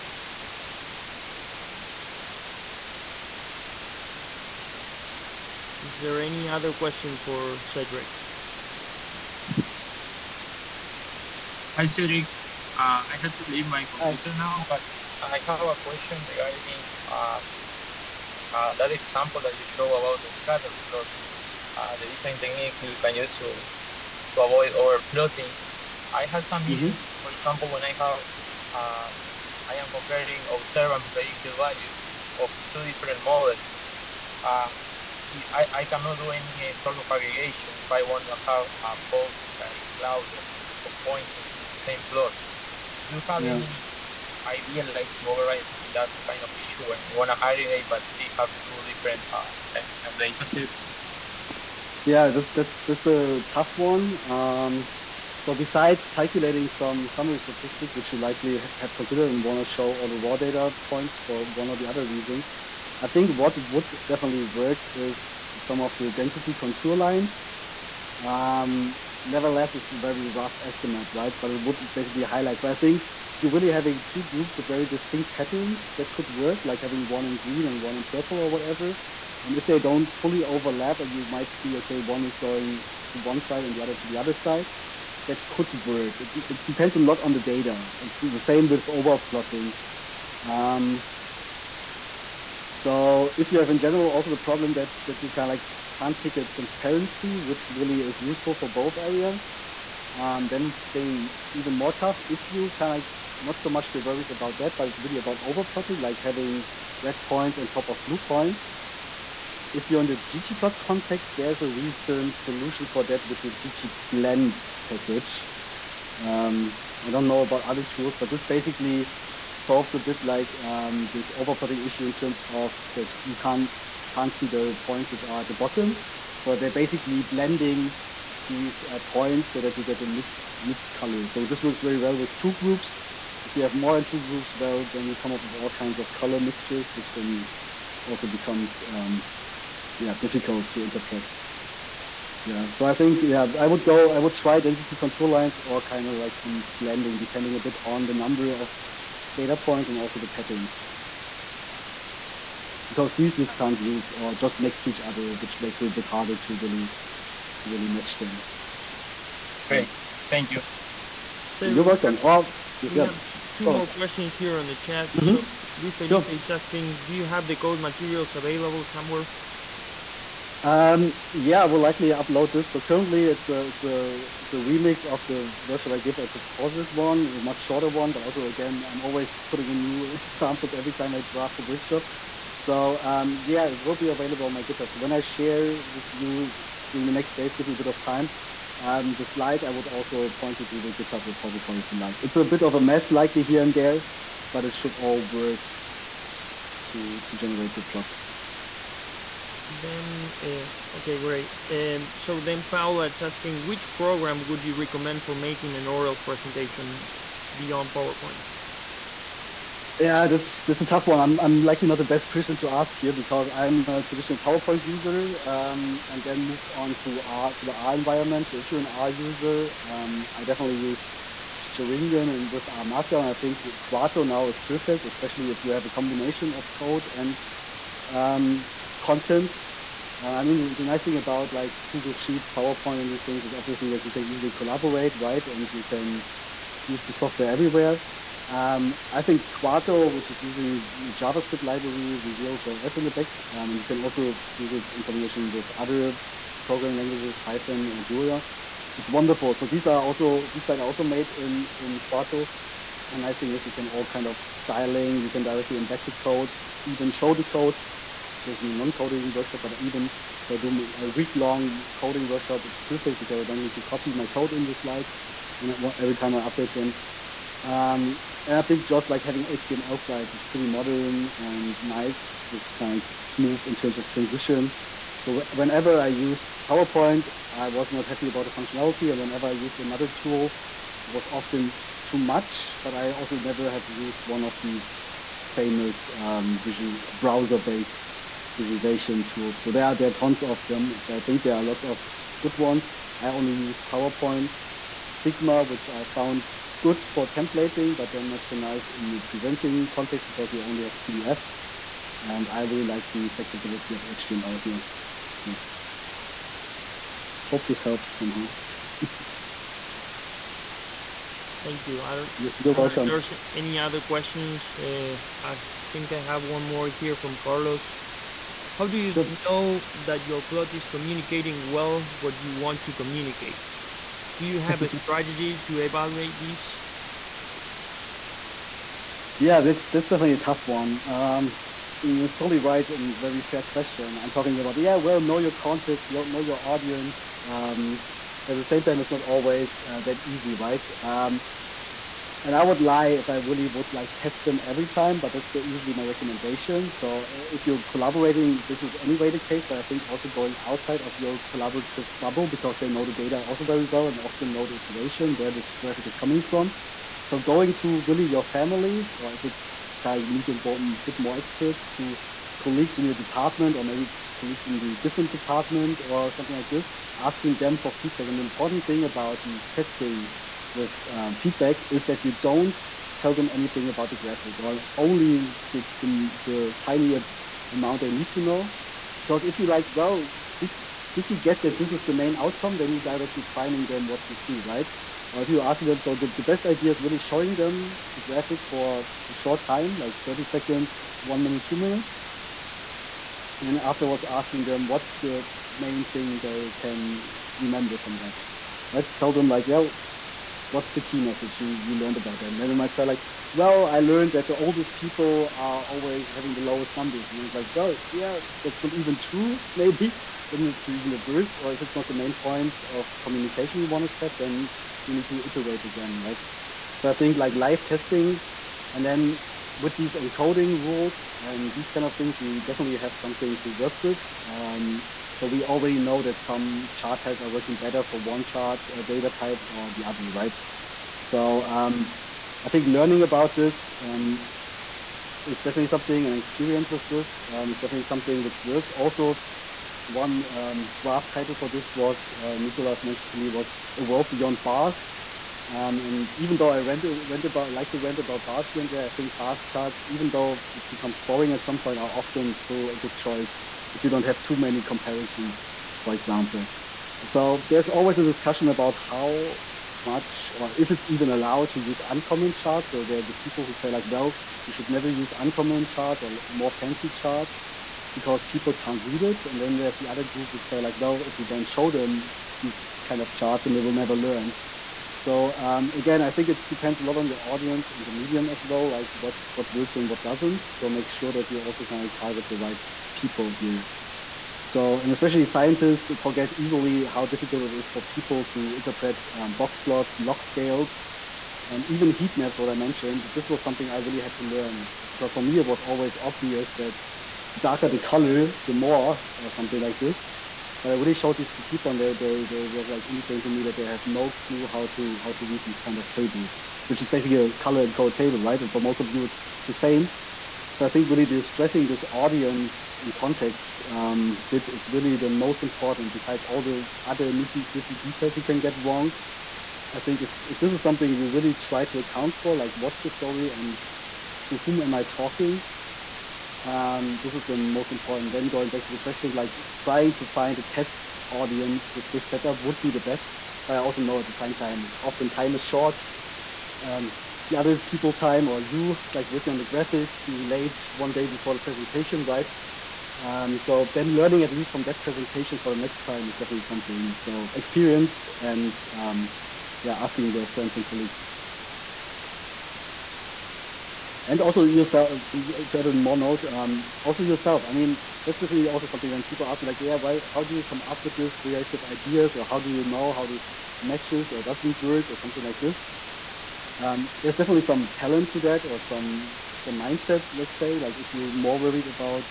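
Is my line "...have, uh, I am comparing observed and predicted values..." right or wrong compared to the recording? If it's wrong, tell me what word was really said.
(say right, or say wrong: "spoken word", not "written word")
right.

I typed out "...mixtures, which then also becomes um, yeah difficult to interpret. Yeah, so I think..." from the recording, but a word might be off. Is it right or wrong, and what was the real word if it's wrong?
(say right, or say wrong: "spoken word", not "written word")
right.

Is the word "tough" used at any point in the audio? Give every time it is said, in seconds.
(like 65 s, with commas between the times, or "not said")
53 s, 101 s, 210 s, 330 s.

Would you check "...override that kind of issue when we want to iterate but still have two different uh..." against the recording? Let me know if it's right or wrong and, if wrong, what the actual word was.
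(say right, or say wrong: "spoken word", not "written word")
wrong: "aggregate", not "iterate".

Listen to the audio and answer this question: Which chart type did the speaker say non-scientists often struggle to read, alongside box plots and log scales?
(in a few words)
heat maps.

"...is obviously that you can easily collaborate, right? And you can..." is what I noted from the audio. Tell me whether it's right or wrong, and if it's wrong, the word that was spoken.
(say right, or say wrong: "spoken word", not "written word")
right.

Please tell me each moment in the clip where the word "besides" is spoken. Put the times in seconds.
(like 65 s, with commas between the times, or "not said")
55 s, 516 s.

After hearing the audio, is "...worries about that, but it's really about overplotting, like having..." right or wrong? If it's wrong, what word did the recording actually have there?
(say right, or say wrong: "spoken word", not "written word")
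right.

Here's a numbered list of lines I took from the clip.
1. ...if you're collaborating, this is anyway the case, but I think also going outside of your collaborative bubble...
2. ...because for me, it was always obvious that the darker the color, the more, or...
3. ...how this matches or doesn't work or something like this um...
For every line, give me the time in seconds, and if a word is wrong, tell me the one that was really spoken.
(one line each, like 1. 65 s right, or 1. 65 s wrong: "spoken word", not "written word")
1. 347 s right
2. 495 s right
3. 563 s right.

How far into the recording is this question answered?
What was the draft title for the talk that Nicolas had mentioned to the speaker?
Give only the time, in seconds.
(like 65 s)
443 s.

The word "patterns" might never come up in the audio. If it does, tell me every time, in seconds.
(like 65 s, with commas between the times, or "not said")
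75 s, 150 s.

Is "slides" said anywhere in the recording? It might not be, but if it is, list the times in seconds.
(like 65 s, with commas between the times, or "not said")
189 s, 250 s, 264 s, 270 s.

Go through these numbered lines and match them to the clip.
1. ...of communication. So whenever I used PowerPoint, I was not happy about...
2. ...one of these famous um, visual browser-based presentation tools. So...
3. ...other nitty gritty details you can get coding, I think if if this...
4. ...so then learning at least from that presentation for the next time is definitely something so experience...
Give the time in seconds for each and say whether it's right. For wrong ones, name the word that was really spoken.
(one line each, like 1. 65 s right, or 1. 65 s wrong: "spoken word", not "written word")
1. 273 s wrong: "transition", not "communication"
2. 284 s wrong: "visualization", not "presentation"
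3. 517 s wrong: "wrong", not "coding"
4. 543 s right.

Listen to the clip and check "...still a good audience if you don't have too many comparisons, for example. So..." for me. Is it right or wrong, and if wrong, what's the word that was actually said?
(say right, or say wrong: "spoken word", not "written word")
wrong: "choice", not "audience".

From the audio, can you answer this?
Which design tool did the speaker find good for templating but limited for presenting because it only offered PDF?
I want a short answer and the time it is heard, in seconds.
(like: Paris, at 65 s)
Figma, at 295 s.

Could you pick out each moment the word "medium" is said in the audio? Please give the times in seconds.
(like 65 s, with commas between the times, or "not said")
478 s.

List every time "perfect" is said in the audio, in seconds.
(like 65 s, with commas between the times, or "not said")
224 s, 262 s.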